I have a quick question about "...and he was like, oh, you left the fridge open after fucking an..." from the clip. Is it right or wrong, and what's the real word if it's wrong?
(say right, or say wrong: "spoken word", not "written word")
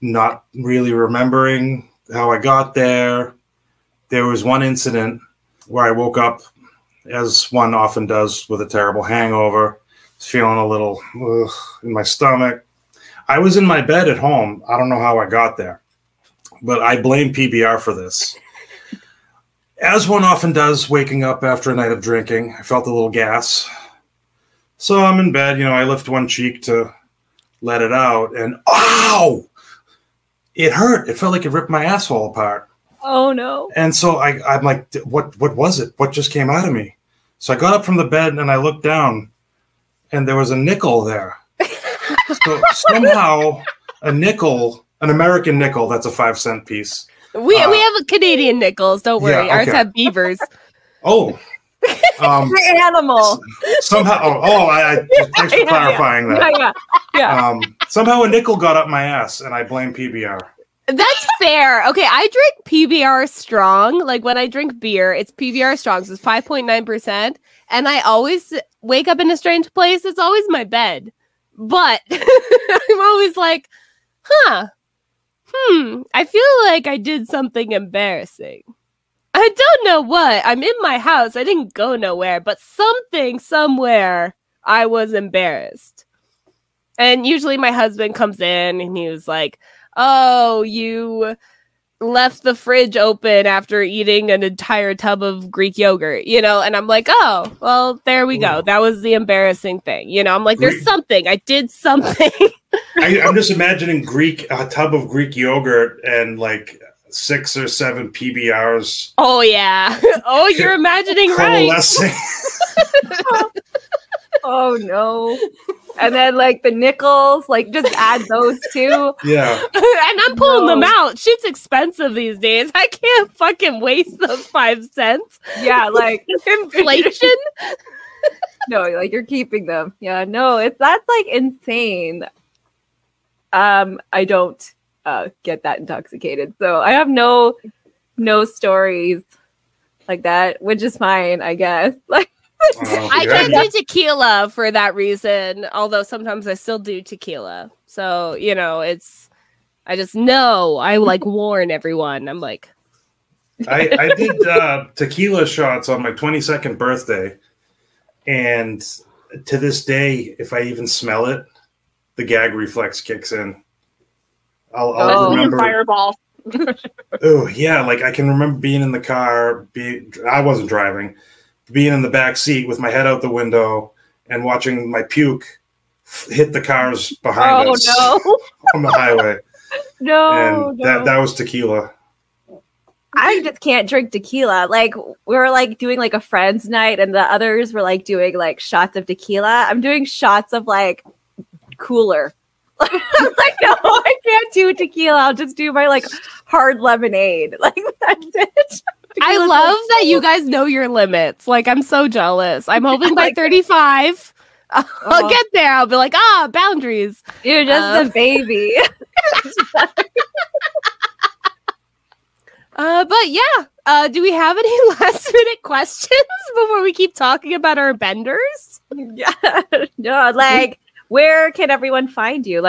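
wrong: "eating", not "fucking".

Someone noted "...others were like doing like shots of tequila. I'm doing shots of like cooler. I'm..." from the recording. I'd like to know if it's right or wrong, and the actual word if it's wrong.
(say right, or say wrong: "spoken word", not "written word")
right.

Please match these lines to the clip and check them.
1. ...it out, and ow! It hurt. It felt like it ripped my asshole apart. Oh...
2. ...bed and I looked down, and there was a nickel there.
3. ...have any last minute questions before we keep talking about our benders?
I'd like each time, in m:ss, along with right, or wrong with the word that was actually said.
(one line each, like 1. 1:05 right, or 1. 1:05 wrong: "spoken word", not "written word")
1. 0:27 right
2. 0:38 right
3. 3:34 right.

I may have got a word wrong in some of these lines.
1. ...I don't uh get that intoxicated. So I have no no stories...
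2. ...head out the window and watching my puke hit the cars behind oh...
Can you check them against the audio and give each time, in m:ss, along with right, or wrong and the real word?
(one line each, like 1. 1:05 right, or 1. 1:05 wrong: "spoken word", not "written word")
1. 2:14 right
2. 2:52 right.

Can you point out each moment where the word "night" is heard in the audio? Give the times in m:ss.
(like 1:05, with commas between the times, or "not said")
0:21, 3:06.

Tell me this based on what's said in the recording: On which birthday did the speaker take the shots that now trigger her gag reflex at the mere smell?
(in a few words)
22nd.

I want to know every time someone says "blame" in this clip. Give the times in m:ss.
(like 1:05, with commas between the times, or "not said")
0:17, 0:59.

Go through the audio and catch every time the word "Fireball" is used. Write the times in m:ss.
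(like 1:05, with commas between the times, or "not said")
2:45.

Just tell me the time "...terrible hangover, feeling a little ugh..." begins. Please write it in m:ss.
0:08.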